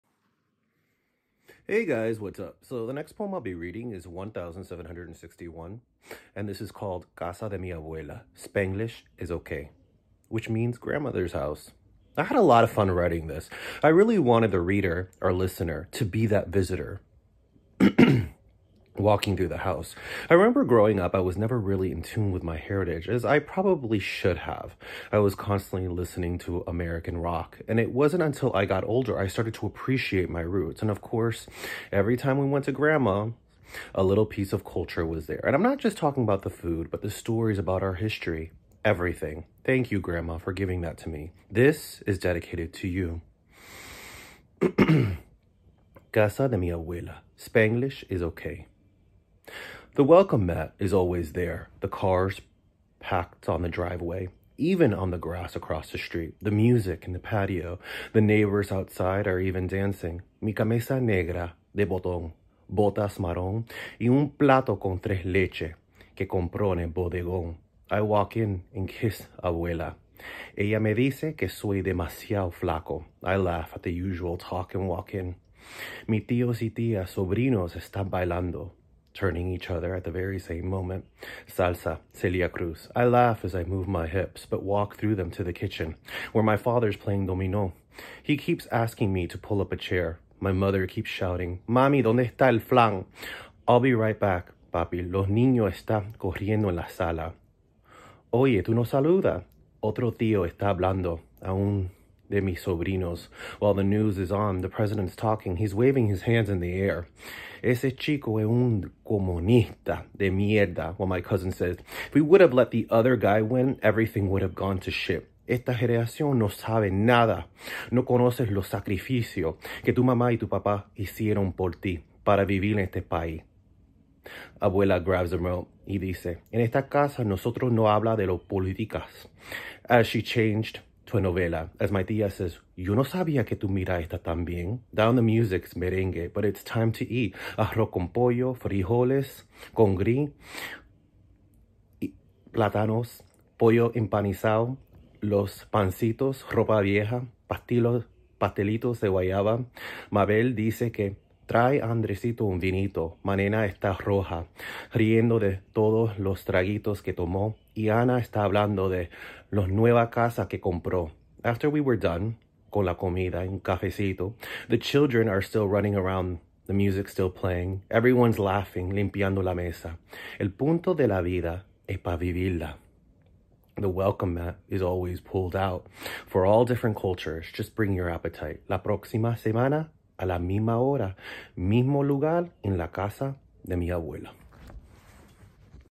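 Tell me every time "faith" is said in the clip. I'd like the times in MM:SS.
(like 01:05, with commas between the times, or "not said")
not said.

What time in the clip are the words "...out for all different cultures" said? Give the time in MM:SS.
02:55.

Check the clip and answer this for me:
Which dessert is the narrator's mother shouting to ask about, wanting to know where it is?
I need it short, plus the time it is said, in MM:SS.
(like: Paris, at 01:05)
Flan, at 01:32.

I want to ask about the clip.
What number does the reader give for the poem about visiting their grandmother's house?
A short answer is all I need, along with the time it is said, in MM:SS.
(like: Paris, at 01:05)
1761, at 00:04.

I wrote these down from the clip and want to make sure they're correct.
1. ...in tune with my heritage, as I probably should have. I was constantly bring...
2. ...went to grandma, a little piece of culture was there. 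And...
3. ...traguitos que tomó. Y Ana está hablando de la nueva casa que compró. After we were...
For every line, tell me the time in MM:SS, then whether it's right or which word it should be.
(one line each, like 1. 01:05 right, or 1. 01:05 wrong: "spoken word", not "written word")
1. 00:21 wrong: "listening", not "bring"
2. 00:32 right
3. 02:36 right.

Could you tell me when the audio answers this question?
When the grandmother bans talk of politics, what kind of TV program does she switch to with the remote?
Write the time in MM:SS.
02:11.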